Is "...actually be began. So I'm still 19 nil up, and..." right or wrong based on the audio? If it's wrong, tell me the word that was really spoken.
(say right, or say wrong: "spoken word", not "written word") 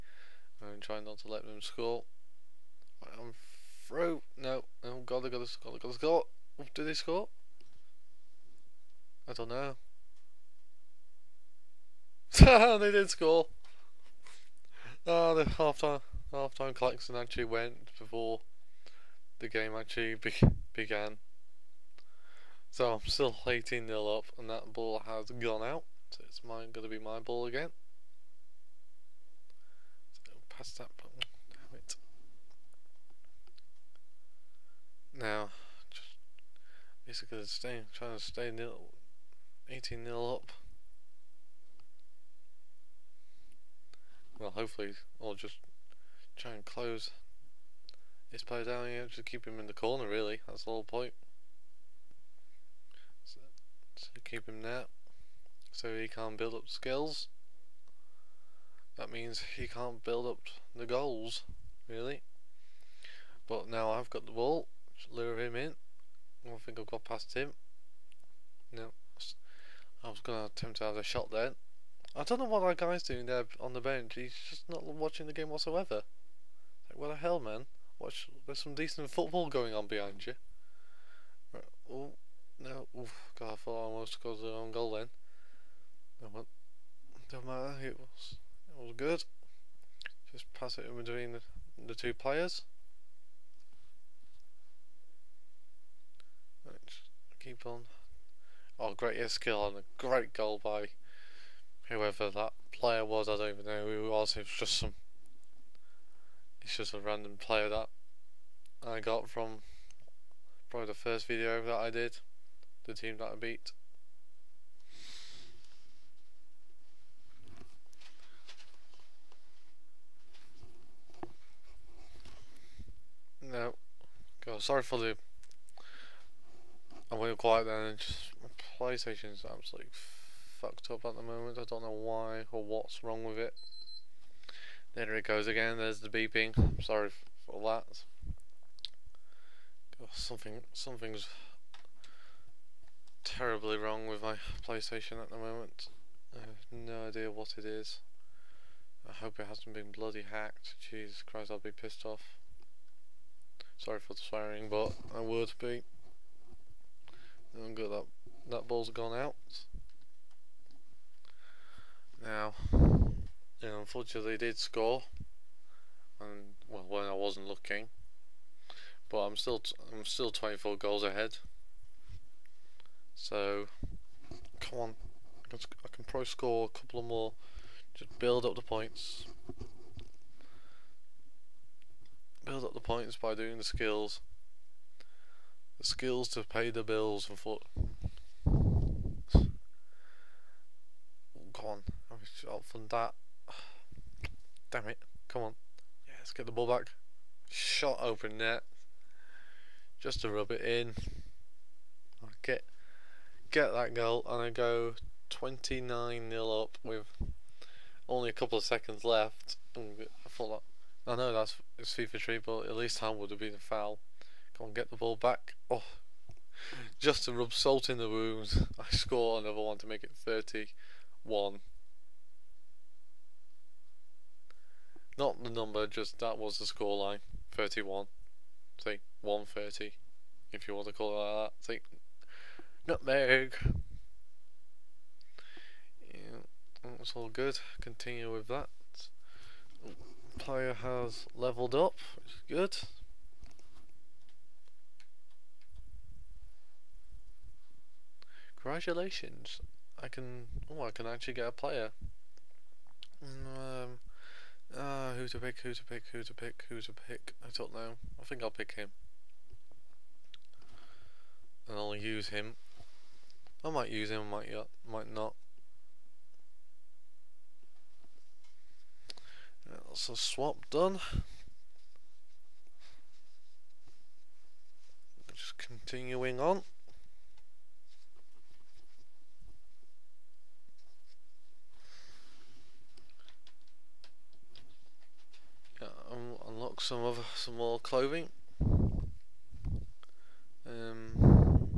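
wrong: "18", not "19".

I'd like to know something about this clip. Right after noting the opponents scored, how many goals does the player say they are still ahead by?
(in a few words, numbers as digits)
24.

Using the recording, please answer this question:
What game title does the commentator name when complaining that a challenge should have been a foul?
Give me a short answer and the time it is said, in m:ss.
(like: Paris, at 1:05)
FIFA Street, at 3:31.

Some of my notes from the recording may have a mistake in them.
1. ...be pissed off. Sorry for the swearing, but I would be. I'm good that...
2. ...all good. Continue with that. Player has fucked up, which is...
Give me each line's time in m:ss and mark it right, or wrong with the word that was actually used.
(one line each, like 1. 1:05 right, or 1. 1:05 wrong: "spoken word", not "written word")
1. 2:31 right
2. 3:57 wrong: "leveled", not "fucked".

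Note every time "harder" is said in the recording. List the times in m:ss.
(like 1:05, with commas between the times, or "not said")
not said.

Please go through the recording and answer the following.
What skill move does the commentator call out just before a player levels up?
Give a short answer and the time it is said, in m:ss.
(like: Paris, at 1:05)
Nutmeg, at 3:52.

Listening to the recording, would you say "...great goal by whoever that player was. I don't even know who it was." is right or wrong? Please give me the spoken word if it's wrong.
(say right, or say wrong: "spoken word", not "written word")
right.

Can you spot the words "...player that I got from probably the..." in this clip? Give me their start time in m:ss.
1:47.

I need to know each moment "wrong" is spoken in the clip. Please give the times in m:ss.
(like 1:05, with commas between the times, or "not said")
1:24, 2:13, 2:23.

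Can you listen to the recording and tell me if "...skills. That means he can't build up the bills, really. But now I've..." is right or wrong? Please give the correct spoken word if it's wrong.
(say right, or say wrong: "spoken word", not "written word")
wrong: "goals", not "bills".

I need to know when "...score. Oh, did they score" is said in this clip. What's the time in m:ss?
0:05.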